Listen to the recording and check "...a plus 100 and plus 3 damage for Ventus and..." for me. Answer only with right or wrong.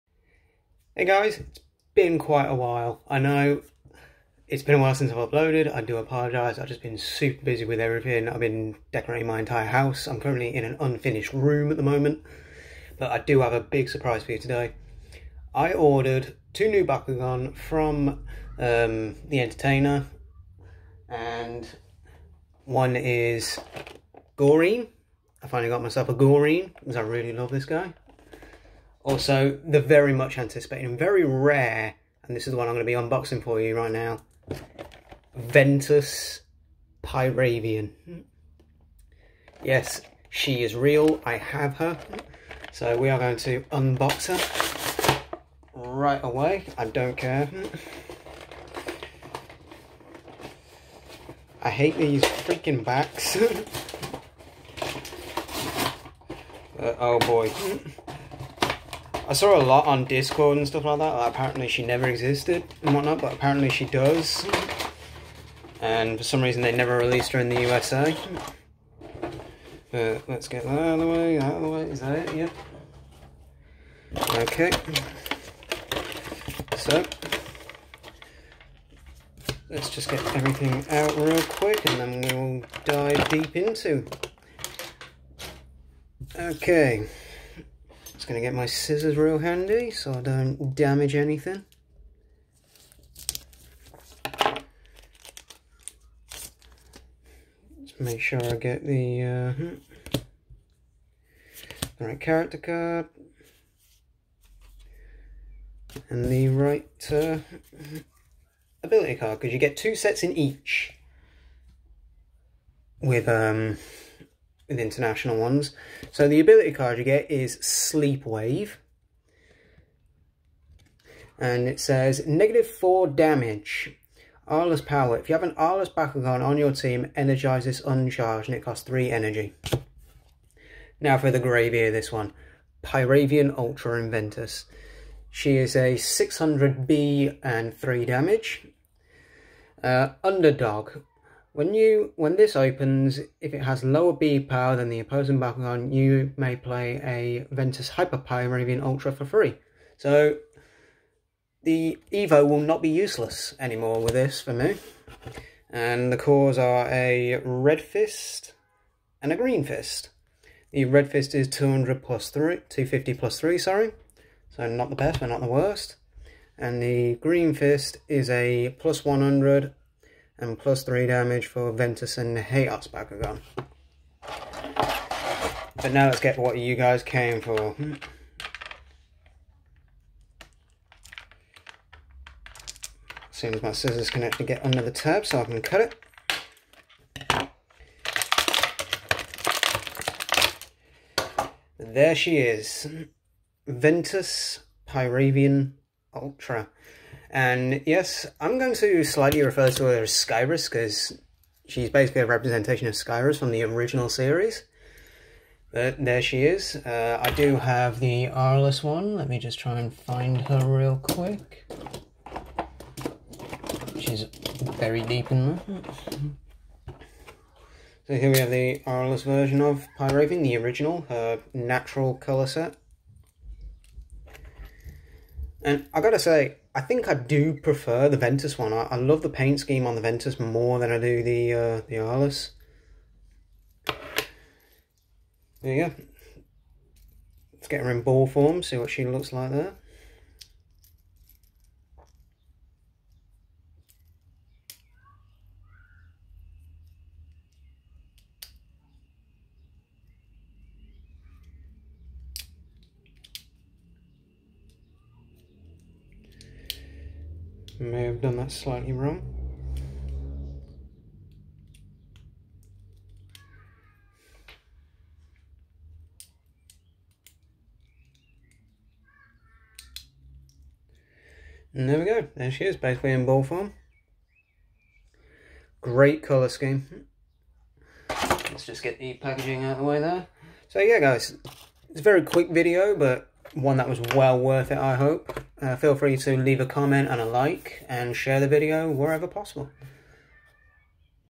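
right.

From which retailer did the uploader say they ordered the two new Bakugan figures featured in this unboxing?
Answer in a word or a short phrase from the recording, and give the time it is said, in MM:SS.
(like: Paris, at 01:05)
The Entertainer, at 00:19.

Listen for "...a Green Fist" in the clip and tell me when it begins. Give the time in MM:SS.
02:39.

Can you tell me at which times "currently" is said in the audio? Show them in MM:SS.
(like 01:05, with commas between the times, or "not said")
00:10.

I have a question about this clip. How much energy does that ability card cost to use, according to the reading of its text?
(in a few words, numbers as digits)
3.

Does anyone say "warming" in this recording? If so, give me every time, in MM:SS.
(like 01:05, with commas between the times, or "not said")
not said.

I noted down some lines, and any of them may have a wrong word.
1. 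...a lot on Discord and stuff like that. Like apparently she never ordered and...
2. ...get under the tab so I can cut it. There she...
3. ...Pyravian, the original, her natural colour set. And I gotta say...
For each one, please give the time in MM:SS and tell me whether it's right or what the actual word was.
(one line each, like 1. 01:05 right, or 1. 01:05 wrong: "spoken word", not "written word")
1. 00:59 wrong: "existed", not "ordered"
2. 03:04 right
3. 03:39 right.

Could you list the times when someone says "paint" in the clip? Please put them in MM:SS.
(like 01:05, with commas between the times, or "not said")
03:49.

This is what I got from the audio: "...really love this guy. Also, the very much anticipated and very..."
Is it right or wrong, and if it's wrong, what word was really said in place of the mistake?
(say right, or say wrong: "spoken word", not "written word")
right.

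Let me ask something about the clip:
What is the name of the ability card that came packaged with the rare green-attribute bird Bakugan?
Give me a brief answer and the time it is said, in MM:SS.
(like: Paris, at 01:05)
Sleepwave, at 01:57.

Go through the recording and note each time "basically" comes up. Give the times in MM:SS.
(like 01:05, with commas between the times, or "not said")
03:21, 04:32.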